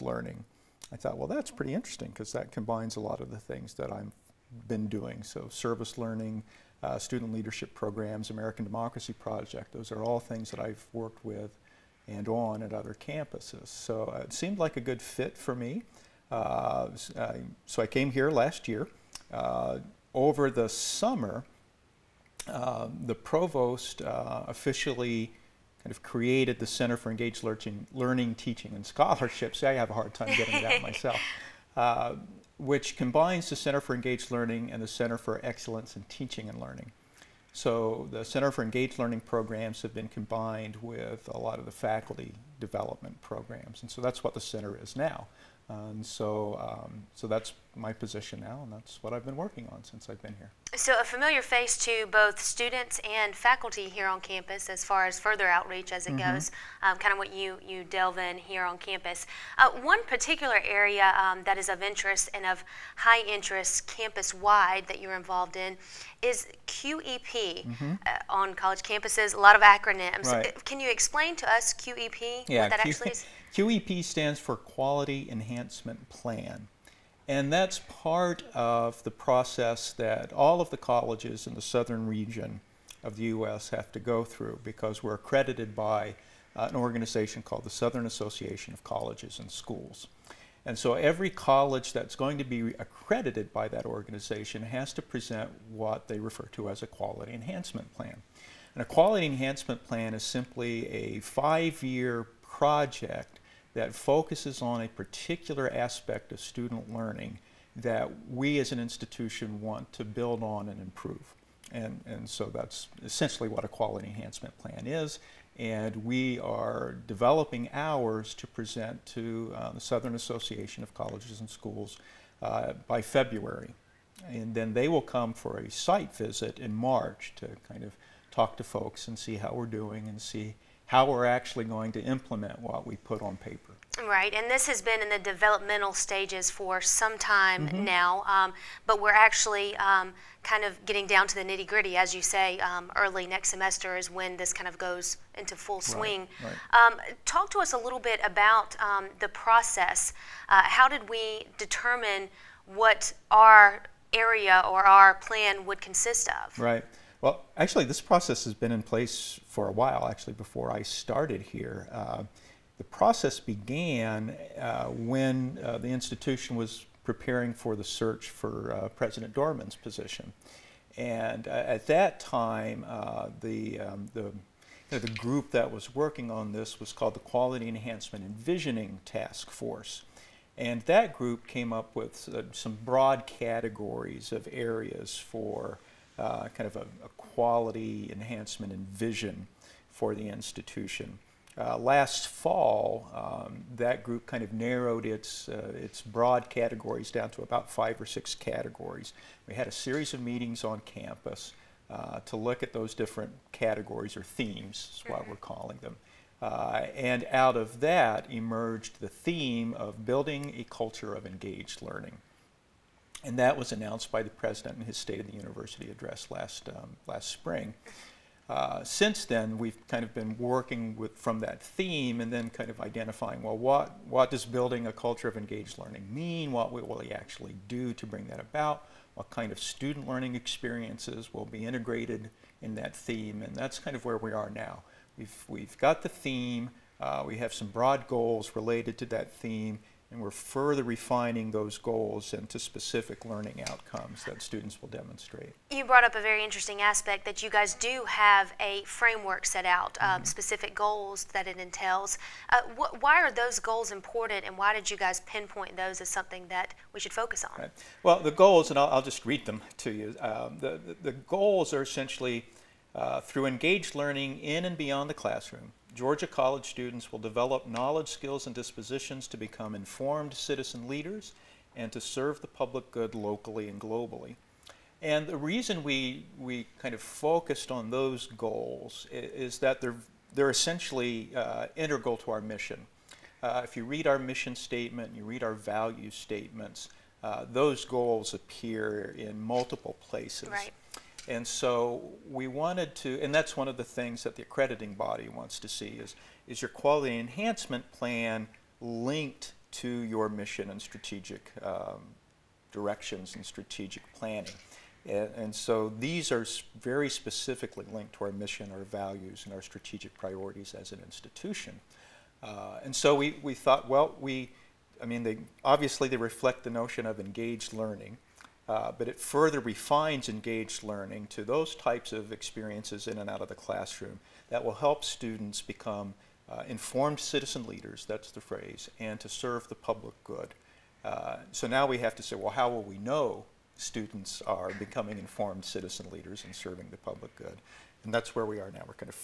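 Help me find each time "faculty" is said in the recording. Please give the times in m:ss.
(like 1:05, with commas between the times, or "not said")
0:41, 0:53.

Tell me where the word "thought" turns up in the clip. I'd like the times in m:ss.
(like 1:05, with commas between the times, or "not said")
0:00, 5:13.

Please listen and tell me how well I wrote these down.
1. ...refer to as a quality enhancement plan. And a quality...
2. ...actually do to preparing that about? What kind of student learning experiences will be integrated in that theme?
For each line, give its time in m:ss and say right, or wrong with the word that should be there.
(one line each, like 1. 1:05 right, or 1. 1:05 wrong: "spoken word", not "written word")
1. 1:36 right
2. 3:47 wrong: "bring", not "preparing".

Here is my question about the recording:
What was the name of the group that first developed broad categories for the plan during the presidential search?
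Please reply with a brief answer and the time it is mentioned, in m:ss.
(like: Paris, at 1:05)
Quality Enhancement and Visioning Task Force, at 2:57.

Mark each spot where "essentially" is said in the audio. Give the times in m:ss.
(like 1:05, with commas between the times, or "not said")
1:53, 4:21, 4:40.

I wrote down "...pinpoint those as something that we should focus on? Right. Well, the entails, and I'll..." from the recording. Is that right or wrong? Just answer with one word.
wrong.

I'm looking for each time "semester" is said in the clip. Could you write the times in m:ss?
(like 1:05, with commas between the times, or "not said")
2:23.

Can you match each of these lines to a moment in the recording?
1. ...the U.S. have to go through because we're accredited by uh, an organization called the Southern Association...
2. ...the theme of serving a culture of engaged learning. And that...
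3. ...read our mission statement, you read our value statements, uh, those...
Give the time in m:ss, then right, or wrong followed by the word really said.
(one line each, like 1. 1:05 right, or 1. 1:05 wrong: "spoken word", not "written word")
1. 1:23 right
2. 3:28 wrong: "building", not "serving"
3. 4:43 right.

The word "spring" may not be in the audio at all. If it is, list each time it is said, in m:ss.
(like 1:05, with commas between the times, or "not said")
3:37.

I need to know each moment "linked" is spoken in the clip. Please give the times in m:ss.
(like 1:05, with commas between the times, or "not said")
4:58, 5:07.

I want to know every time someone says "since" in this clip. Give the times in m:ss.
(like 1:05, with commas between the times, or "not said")
0:49, 3:38.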